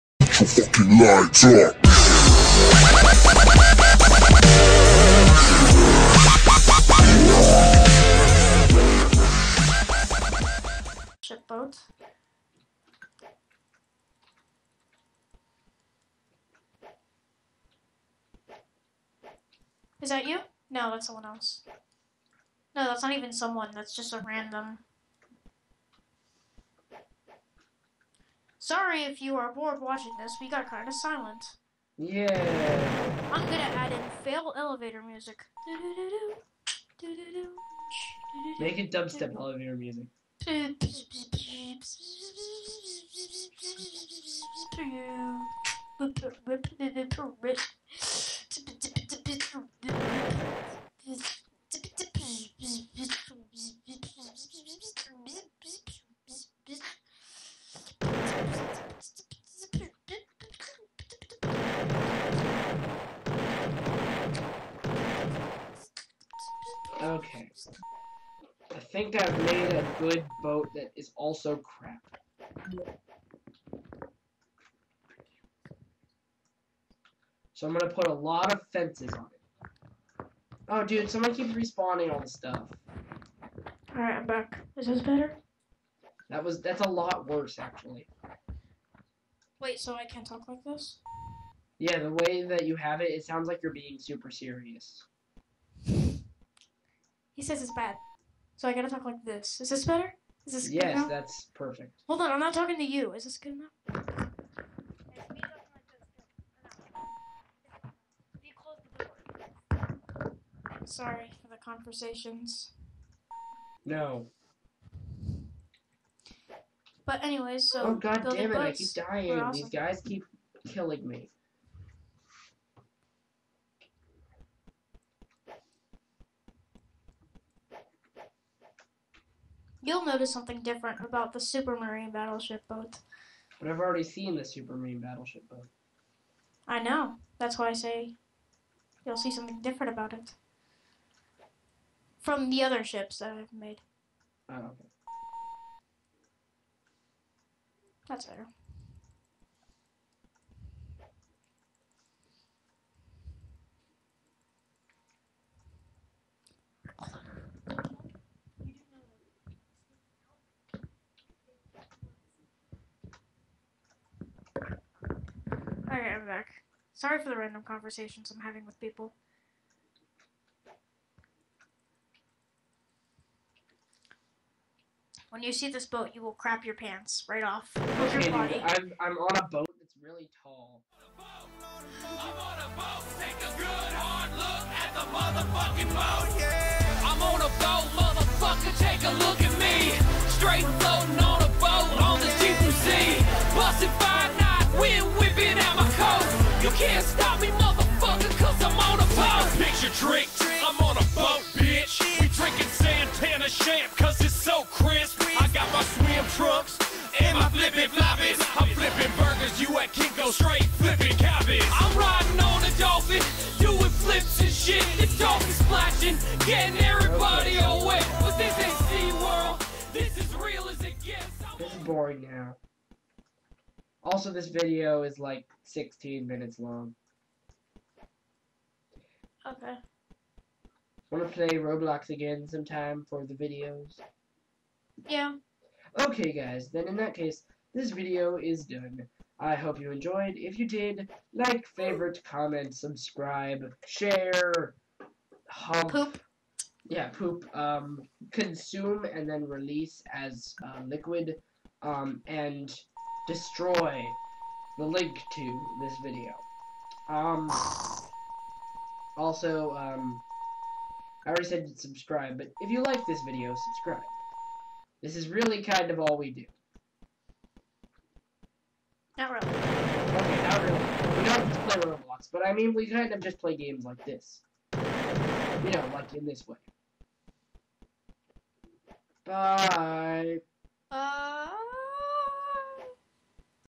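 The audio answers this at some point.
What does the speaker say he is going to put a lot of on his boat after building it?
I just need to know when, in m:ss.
1:18.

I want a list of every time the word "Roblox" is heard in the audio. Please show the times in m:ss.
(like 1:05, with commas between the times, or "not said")
3:51, 4:31.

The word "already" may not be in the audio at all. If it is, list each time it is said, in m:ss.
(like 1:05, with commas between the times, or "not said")
2:13, 4:21.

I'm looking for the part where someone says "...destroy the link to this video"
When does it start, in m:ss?
4:13.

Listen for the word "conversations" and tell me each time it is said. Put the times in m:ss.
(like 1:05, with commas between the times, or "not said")
1:51, 2:47.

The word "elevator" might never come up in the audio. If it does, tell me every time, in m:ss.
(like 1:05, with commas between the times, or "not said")
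0:34, 0:39.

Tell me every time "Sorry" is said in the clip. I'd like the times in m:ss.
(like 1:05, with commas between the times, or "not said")
0:28, 1:50, 2:46.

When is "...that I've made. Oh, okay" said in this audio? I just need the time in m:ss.
2:23.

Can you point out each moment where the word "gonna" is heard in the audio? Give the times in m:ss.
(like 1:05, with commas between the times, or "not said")
0:33, 1:17.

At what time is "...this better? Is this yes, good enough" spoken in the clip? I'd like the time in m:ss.
1:39.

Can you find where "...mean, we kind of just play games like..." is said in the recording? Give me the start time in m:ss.
4:32.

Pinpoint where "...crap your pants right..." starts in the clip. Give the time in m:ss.
2:56.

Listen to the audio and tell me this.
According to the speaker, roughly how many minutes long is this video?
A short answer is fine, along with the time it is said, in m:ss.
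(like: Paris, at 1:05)
16, at 3:45.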